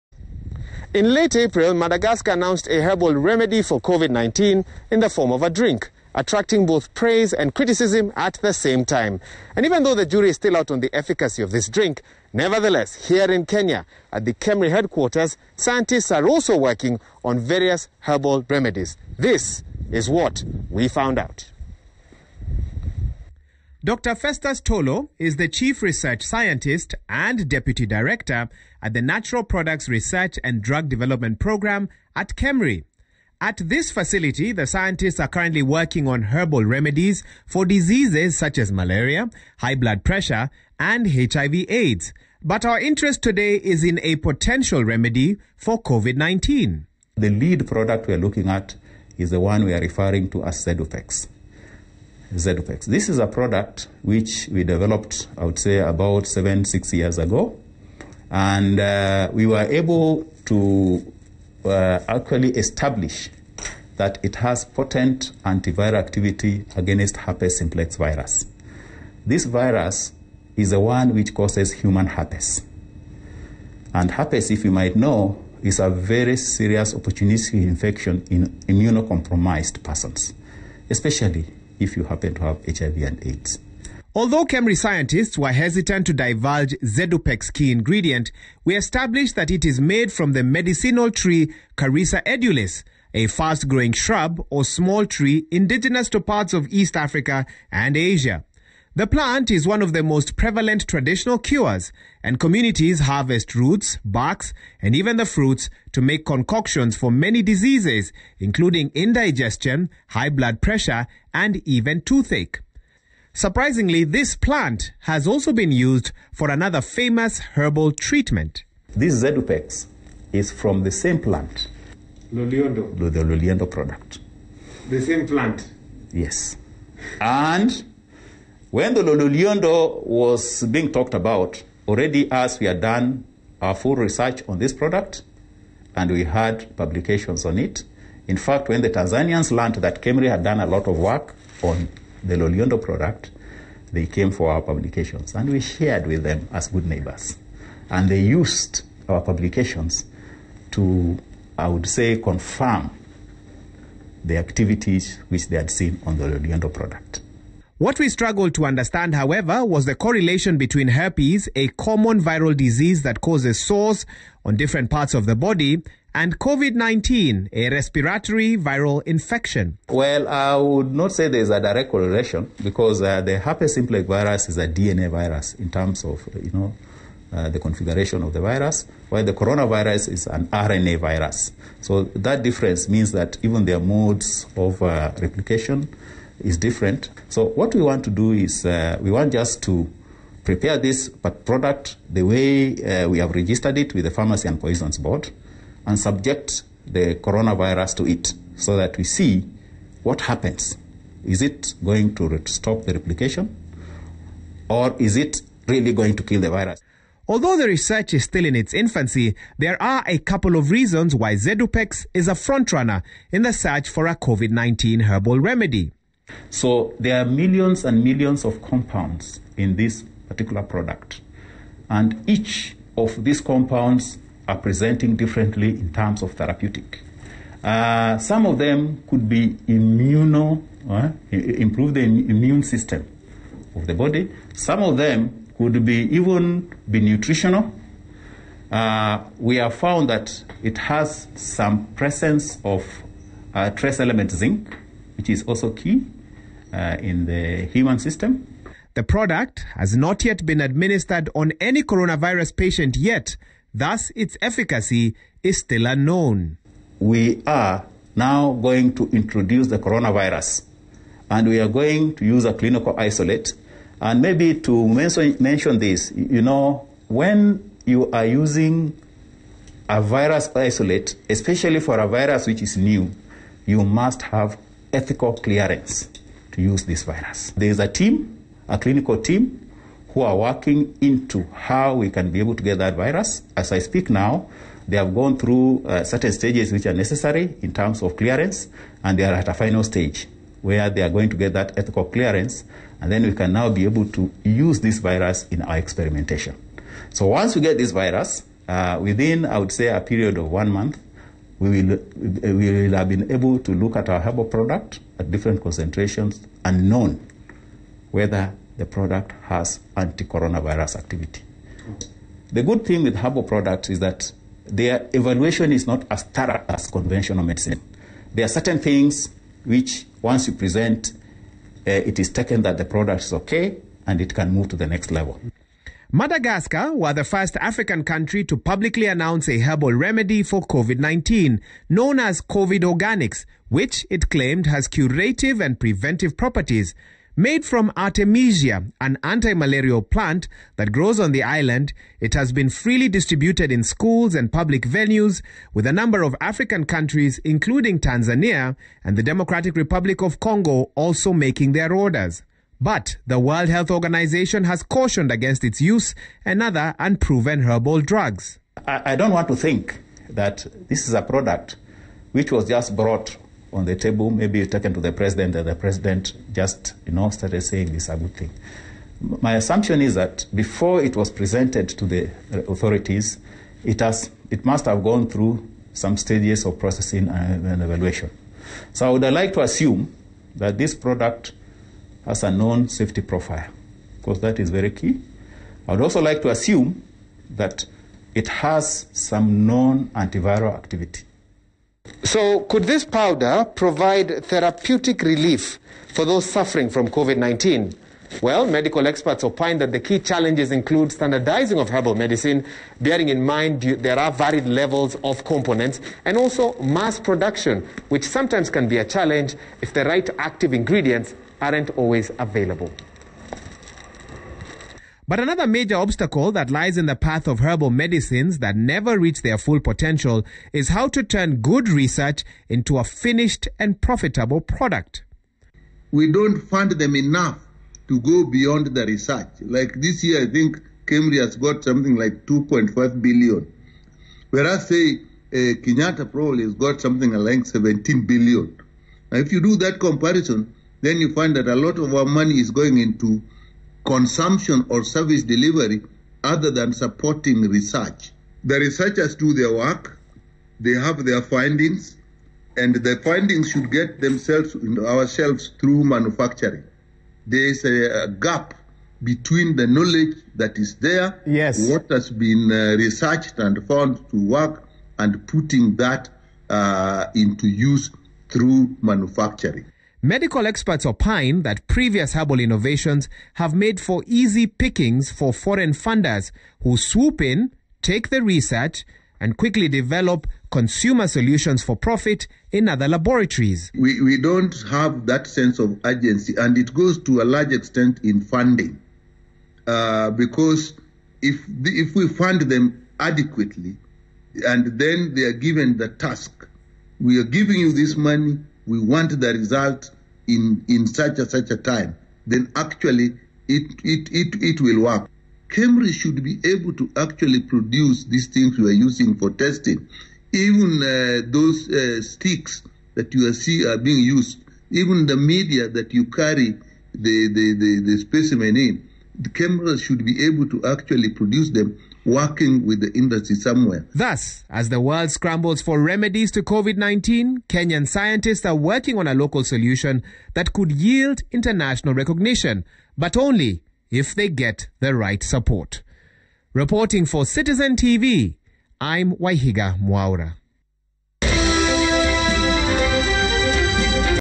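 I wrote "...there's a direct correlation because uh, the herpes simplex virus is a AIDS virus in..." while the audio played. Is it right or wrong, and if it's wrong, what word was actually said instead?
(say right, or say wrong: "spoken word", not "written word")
wrong: "DNA", not "AIDS".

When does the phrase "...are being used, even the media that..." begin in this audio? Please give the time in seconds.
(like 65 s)
513 s.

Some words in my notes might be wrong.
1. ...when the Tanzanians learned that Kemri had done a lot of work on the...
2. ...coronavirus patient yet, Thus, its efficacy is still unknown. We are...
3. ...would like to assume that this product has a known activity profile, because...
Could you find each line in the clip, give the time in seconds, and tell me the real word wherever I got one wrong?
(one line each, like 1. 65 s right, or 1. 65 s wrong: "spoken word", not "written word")
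1. 138 s right
2. 251 s right
3. 379 s wrong: "safety", not "activity".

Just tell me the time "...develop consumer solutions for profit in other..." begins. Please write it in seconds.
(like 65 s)
479 s.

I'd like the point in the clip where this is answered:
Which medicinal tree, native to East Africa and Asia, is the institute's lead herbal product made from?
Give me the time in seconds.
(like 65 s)
91 s.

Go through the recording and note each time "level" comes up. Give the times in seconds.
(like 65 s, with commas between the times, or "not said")
325 s, 404 s.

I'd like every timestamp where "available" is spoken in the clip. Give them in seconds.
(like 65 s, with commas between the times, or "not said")
412 s.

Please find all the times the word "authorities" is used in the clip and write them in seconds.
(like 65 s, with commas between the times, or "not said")
372 s.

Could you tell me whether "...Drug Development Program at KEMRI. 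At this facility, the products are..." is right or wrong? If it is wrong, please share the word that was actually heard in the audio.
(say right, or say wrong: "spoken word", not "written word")
wrong: "scientists", not "products".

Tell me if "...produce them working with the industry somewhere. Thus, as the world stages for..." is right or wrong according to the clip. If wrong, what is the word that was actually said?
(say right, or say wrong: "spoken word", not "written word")
wrong: "scrambles", not "stages".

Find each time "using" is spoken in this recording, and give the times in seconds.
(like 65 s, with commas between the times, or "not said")
268 s, 509 s.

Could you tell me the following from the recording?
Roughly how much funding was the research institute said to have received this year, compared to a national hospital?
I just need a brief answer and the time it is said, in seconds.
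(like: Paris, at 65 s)
2.5 billion, at 432 s.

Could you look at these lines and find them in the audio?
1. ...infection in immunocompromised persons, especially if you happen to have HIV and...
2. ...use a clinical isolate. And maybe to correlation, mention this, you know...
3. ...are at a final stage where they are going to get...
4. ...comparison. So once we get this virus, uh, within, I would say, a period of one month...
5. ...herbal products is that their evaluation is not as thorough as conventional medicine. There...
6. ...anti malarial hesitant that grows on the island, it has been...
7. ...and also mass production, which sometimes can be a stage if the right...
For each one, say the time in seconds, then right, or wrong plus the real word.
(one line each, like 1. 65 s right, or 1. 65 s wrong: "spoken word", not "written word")
1. 77 s right
2. 262 s wrong: "mention", not "correlation"
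3. 289 s right
4. 295 s wrong: "experimentation", not "comparison"
5. 313 s right
6. 339 s wrong: "plant", not "hesitant"
7. 406 s wrong: "challenge", not "stage".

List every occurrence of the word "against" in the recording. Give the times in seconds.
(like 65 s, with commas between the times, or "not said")
66 s, 355 s.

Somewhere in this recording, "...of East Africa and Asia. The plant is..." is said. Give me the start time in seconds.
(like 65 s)
96 s.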